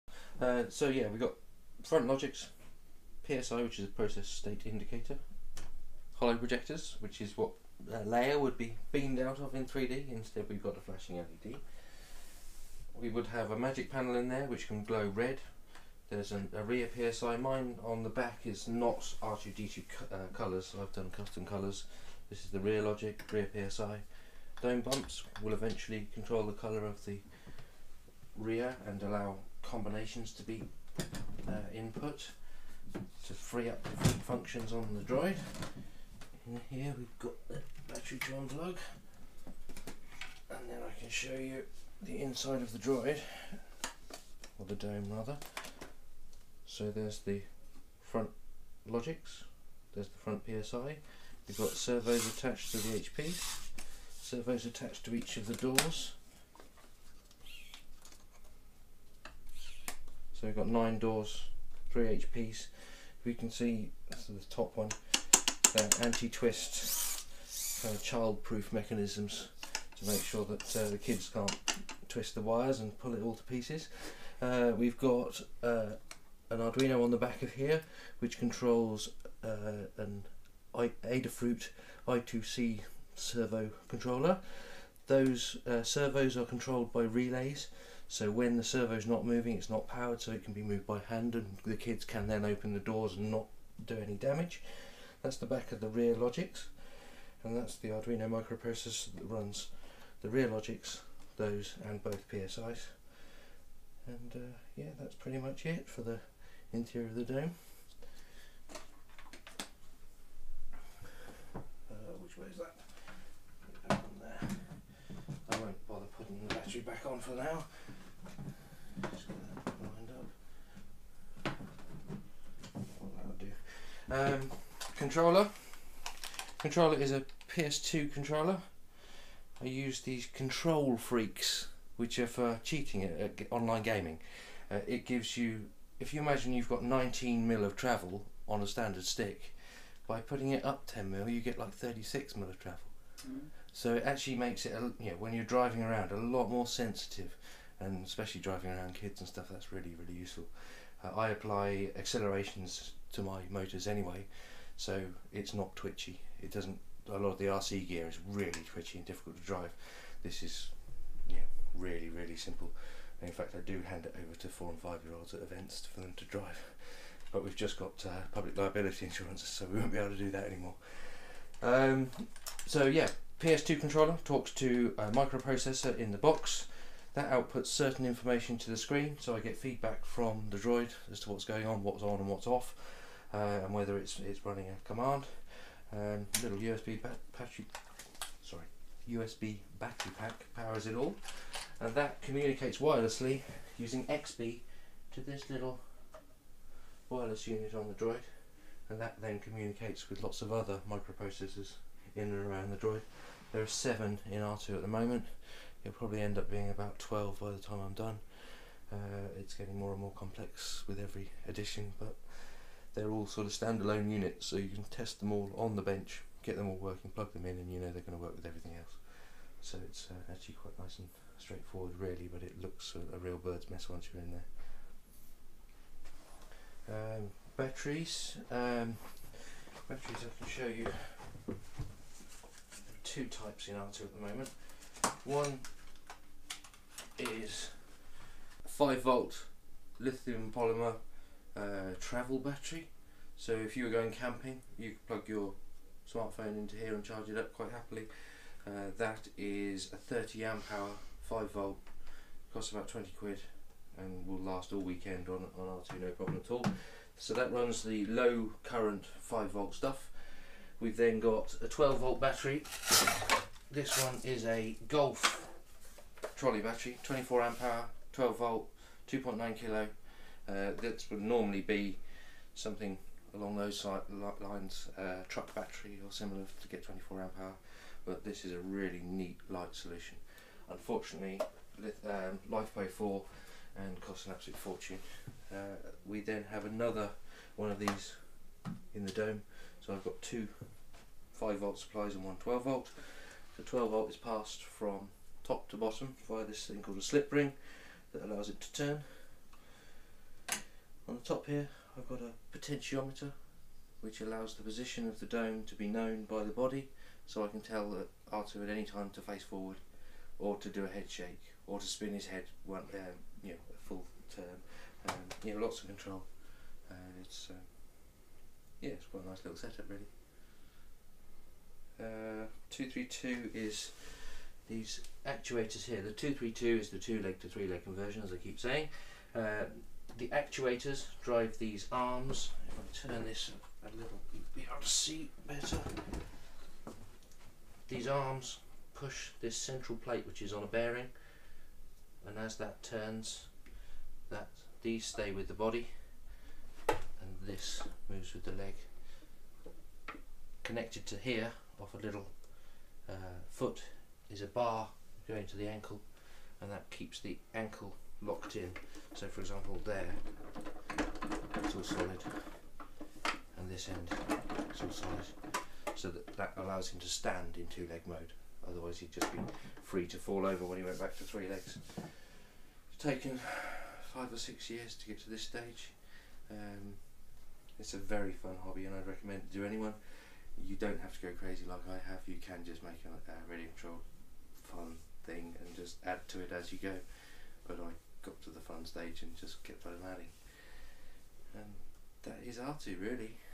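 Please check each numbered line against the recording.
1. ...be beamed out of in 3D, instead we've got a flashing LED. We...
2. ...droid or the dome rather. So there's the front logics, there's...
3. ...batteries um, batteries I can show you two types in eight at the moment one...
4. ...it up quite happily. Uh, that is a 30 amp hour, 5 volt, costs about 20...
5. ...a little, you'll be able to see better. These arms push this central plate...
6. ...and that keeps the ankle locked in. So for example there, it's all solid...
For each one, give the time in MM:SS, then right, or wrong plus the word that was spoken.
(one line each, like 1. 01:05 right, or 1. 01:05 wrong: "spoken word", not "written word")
1. 00:08 right
2. 00:42 right
3. 03:47 wrong: "two", not "eight"
4. 04:07 right
5. 05:33 right
6. 05:56 right.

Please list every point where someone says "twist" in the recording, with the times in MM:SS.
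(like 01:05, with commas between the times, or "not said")
01:06, 01:12.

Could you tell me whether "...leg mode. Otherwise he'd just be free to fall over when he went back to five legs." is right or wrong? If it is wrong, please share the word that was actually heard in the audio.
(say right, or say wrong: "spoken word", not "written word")
wrong: "three", not "five".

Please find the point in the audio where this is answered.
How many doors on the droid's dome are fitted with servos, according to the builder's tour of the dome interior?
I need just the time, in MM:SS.
01:00.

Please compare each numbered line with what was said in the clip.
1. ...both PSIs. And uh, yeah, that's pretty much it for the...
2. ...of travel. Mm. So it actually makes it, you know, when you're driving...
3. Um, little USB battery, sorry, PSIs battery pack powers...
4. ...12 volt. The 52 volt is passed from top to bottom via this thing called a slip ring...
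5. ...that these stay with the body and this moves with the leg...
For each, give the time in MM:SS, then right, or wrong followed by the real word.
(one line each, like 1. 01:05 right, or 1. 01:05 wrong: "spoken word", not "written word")
1. 01:42 right
2. 02:22 right
3. 03:05 wrong: "USB", not "PSIs"
4. 04:52 wrong: "12", not "52"
5. 05:44 right.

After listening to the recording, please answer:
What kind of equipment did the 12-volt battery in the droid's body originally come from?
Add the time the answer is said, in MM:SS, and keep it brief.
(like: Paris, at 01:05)
Golf trolley, at 04:24.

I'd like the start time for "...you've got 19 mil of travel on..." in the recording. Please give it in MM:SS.
02:16.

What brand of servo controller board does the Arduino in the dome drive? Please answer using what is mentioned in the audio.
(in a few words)
Adafruit.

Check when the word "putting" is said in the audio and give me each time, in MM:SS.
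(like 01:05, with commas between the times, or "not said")
01:56, 02:20.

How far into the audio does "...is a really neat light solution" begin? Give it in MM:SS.
04:38.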